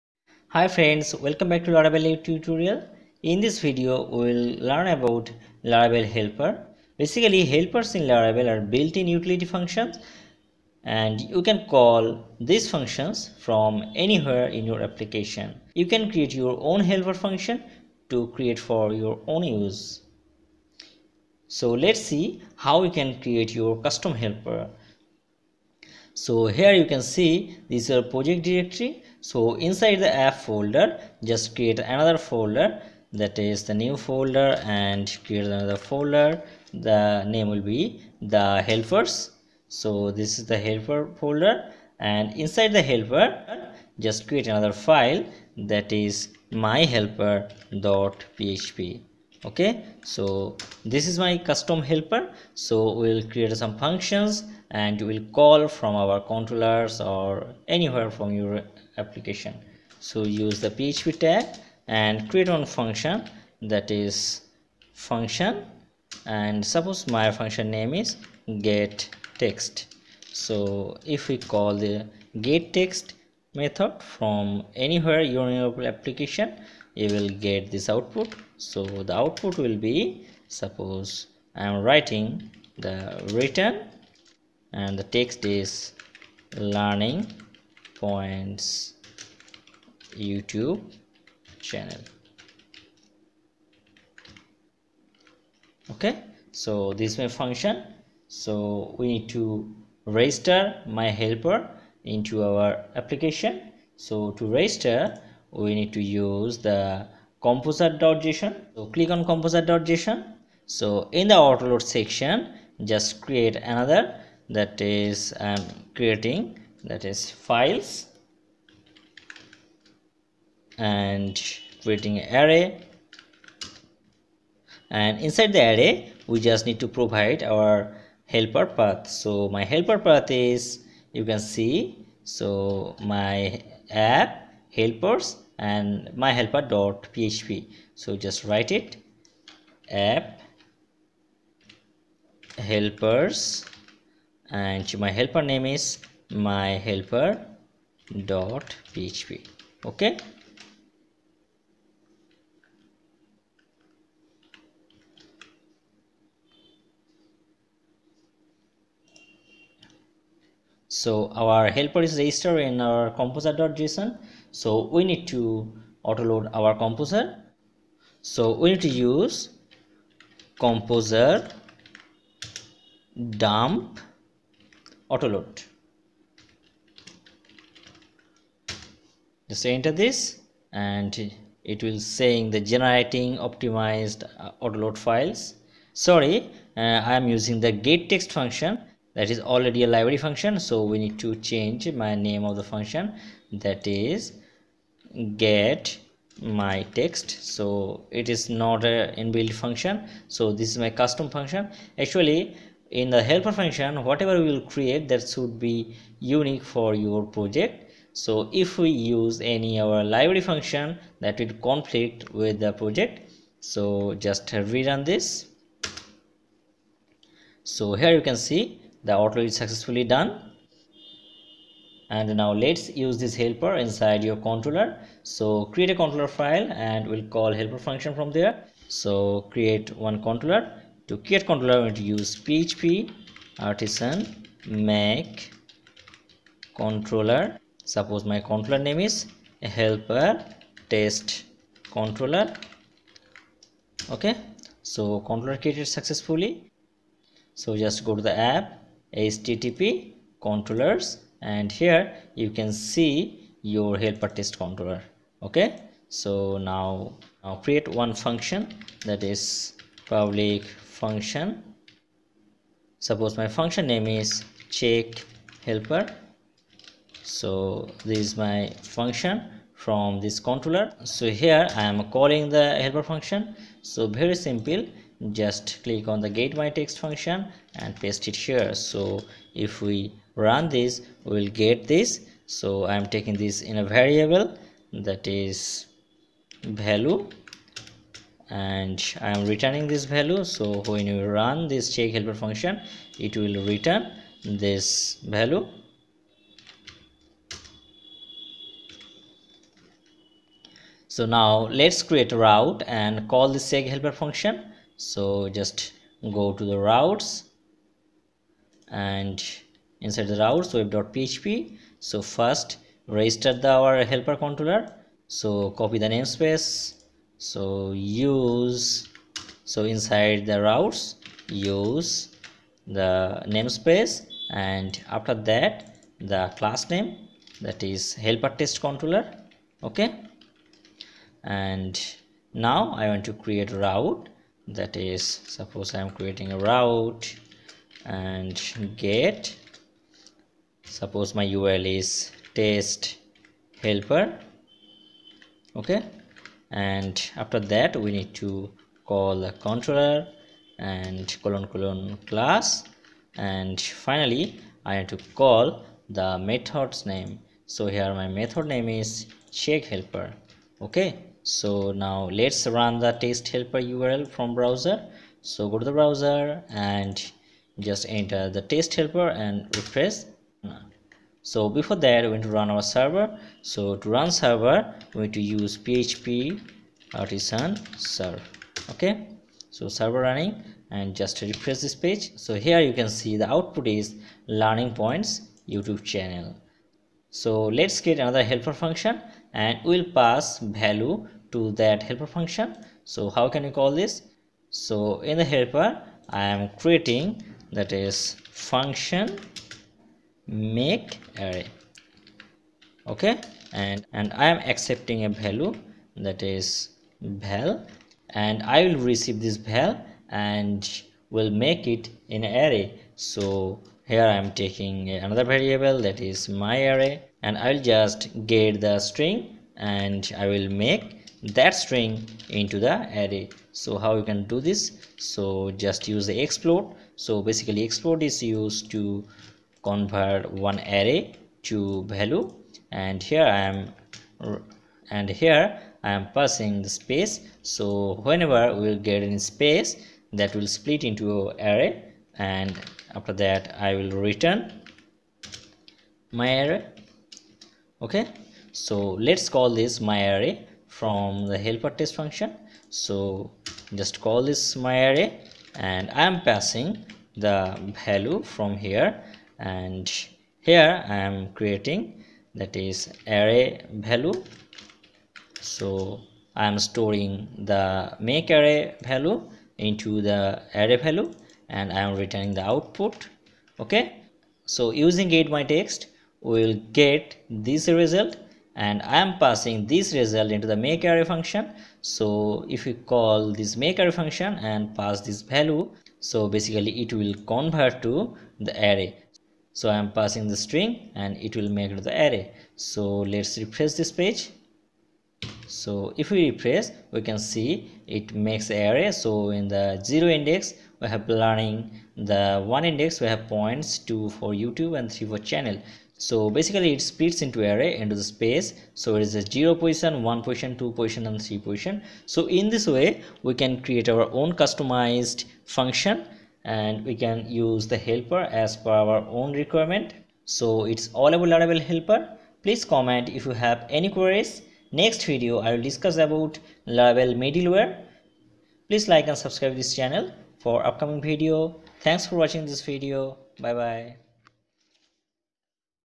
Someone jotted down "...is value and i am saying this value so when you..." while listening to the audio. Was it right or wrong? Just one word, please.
wrong.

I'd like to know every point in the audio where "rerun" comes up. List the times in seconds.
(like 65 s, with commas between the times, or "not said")
214 s.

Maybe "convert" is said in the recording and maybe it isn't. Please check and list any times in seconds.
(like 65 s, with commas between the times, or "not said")
429 s, 487 s.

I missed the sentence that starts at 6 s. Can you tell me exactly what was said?
Basically, helpers in Laravel are built-in utility functions and you can call these functions from anywhere in your application.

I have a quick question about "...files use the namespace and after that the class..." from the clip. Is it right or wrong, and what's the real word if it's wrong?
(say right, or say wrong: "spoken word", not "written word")
wrong: "routes", not "files".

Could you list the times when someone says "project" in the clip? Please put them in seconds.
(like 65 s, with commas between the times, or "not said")
28 s, 207 s, 212 s.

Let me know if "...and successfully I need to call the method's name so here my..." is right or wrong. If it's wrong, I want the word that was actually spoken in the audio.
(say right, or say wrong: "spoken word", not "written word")
wrong: "finally", not "successfully".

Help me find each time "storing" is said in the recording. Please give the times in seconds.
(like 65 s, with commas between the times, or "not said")
466 s.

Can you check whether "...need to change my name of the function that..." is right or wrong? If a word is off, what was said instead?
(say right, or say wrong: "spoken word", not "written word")
right.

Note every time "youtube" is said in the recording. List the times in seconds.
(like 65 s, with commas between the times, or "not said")
90 s, 385 s, 504 s.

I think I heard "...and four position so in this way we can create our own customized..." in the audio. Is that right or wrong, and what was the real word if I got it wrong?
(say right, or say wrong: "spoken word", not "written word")
wrong: "three", not "four".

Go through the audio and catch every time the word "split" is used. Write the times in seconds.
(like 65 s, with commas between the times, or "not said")
440 s, 507 s.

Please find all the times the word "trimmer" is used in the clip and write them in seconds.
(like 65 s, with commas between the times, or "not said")
not said.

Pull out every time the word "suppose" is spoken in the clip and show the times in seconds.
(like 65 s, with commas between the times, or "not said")
66 s, 80 s, 237 s, 263 s, 335 s, 340 s.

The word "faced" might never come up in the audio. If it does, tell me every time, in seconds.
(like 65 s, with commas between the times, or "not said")
not said.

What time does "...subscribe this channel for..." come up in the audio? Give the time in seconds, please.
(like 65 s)
529 s.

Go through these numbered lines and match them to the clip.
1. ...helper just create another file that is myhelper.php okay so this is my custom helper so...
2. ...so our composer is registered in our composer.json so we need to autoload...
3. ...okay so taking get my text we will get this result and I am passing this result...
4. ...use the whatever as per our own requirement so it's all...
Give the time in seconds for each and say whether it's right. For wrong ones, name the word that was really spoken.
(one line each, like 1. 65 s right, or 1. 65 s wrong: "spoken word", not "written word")
1. 42 s right
2. 160 s wrong: "helper", not "composer"
3. 473 s wrong: "using", not "taking"
4. 517 s wrong: "helper", not "whatever".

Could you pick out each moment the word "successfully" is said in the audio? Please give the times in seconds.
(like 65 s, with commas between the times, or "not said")
219 s, 245 s.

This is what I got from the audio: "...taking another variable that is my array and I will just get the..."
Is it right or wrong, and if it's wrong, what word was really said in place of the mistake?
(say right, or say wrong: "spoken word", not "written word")
right.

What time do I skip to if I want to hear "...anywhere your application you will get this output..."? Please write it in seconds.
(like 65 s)
74 s.